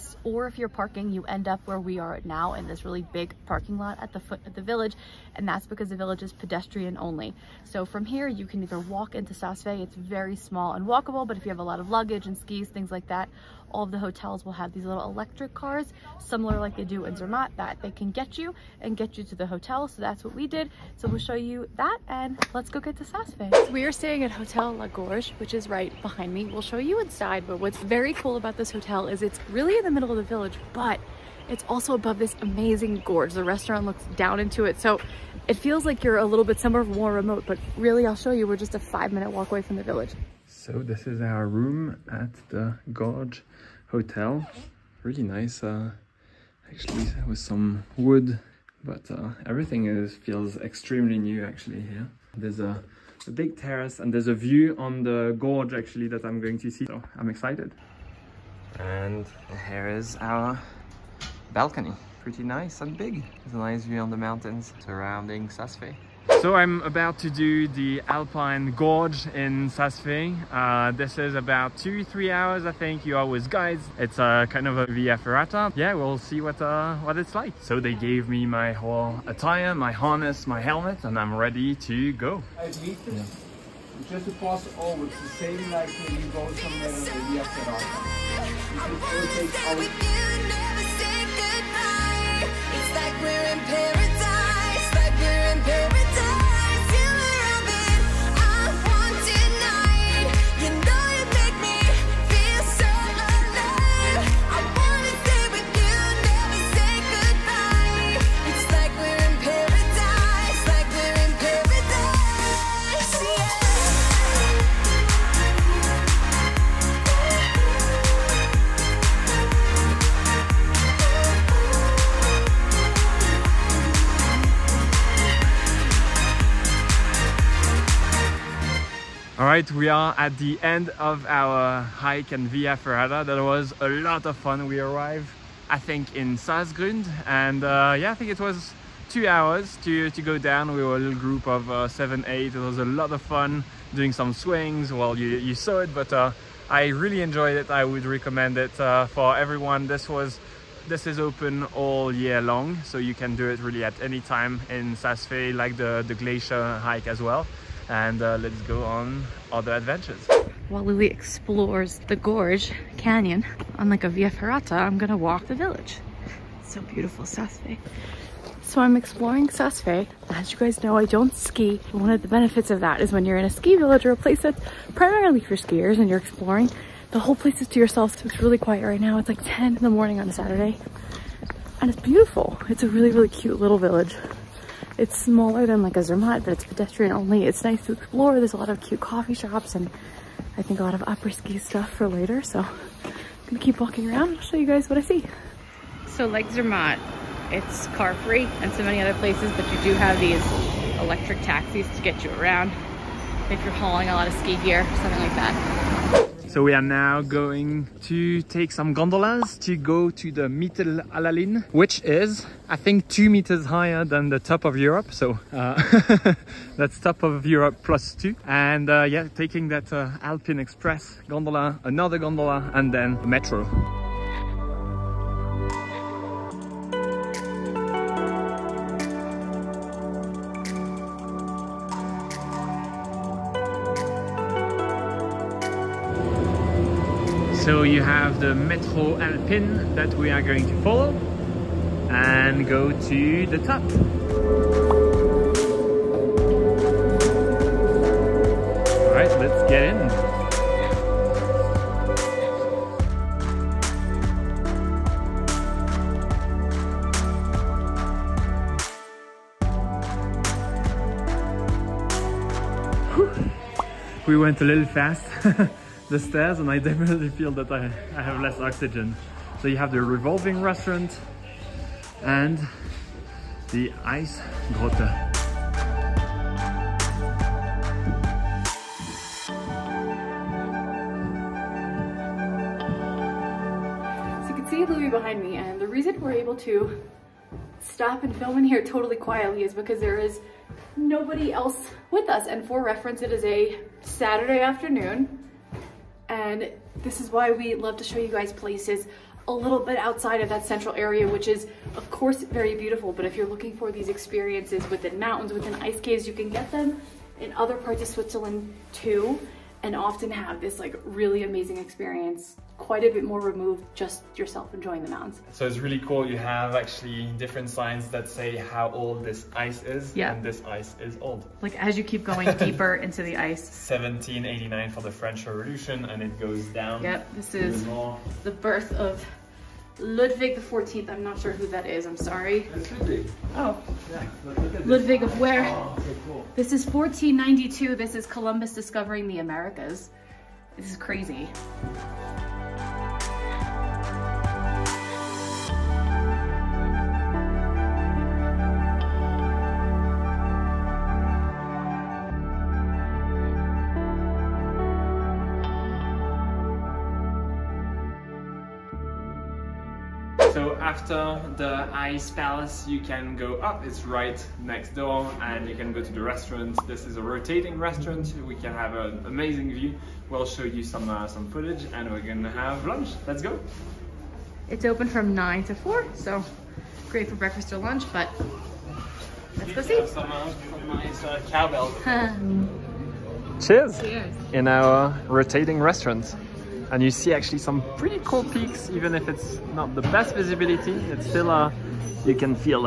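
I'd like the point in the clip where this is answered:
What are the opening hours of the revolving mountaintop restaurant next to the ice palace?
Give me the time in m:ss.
6:15.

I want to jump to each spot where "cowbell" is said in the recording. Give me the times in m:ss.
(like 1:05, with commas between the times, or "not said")
6:21.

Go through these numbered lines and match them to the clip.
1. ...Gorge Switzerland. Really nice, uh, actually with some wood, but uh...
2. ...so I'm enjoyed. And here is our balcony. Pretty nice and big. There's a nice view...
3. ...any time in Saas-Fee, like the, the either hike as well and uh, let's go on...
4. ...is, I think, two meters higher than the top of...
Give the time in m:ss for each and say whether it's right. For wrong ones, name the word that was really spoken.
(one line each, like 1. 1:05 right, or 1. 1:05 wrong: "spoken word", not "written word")
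1. 0:42 wrong: "Hotel", not "Switzerland"
2. 0:56 wrong: "excited", not "enjoyed"
3. 2:33 wrong: "glacier", not "either"
4. 3:32 right.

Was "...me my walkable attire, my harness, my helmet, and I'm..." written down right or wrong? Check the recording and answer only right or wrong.
wrong.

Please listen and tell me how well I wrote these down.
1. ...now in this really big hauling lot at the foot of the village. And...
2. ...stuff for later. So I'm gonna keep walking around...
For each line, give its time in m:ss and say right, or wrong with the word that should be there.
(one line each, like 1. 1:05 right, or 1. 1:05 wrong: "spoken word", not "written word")
1. 0:02 wrong: "parking", not "hauling"
2. 3:11 right.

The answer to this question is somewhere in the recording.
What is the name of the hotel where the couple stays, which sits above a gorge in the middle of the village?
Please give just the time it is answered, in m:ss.
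0:24.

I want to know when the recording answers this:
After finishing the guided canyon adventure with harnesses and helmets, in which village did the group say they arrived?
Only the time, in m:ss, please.
2:16.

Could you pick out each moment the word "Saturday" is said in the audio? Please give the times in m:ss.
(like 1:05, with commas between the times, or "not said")
3:00, 4:53.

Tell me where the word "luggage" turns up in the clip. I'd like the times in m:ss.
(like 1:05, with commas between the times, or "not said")
0:11.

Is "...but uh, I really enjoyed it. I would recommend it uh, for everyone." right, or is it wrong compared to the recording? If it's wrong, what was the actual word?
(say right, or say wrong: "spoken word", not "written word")
right.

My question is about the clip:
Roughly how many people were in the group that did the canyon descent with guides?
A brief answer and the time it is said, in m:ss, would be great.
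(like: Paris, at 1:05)
7 or 8, at 2:21.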